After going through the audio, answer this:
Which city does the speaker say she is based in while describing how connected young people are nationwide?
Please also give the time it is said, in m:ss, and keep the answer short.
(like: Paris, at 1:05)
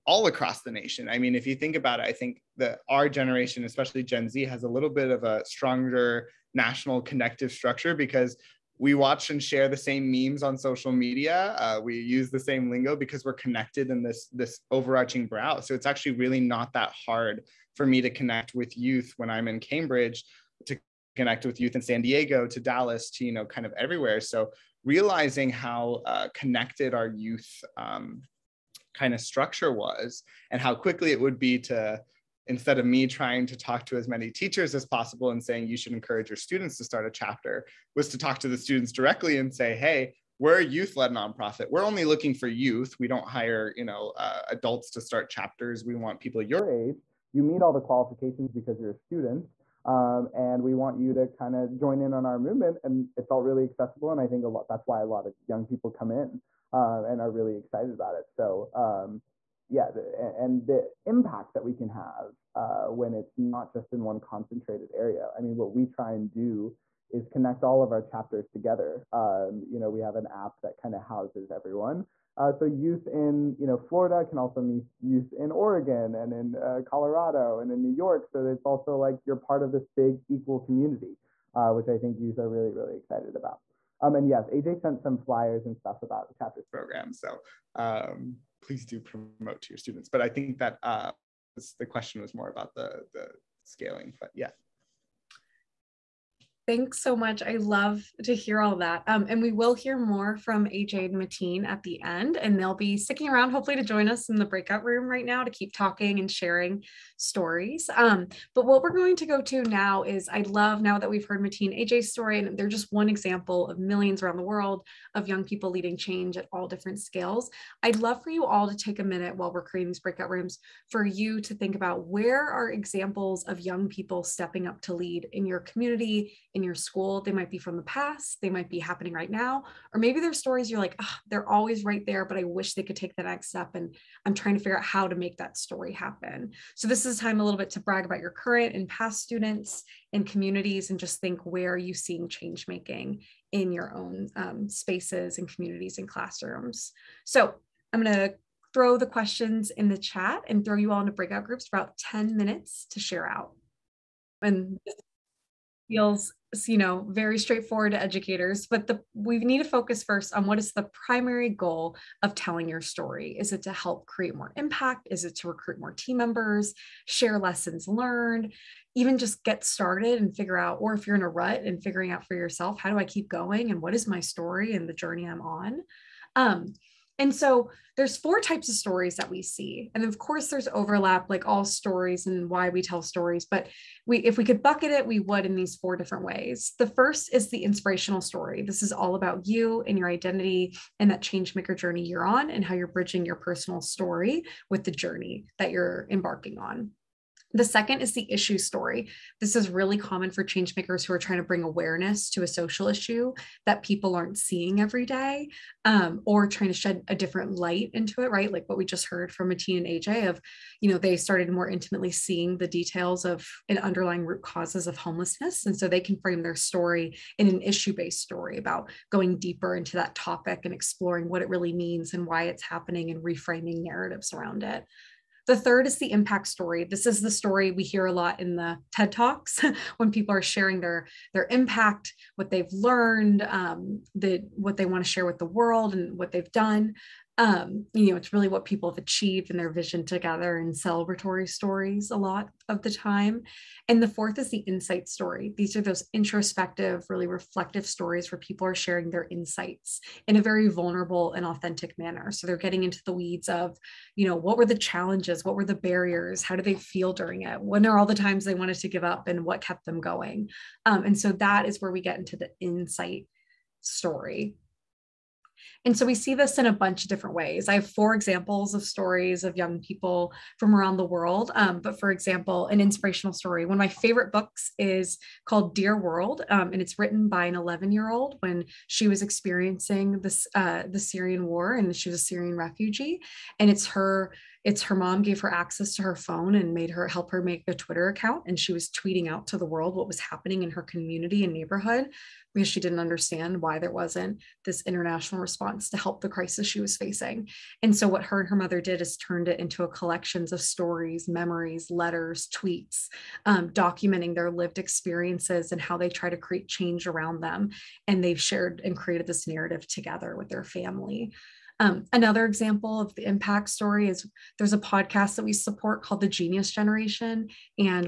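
Cambridge, at 0:19.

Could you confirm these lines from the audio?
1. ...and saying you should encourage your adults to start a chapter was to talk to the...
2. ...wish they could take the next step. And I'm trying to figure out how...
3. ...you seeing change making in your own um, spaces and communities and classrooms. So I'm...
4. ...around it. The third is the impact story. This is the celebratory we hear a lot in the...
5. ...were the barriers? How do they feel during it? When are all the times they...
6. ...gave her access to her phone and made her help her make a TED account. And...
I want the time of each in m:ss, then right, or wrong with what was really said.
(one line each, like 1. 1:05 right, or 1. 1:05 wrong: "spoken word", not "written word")
1. 0:35 wrong: "students", not "adults"
2. 2:12 right
3. 2:21 right
4. 3:44 wrong: "story", not "celebratory"
5. 4:15 right
6. 4:45 wrong: "Twitter", not "TED".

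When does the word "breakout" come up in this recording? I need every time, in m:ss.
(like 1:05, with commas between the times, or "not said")
1:44, 1:59, 2:31.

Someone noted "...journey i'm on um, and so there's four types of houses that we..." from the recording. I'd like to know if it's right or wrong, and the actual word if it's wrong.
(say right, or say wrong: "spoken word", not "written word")
wrong: "stories", not "houses".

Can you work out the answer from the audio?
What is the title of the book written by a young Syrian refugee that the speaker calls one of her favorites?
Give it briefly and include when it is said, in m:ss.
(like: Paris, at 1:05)
Dear World, at 4:35.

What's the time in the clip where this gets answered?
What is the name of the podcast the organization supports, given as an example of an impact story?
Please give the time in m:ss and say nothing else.
5:16.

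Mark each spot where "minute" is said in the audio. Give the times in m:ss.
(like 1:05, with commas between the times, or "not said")
1:59, 2:32.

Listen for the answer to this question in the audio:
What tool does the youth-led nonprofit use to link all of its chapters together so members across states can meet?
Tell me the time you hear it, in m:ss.
1:10.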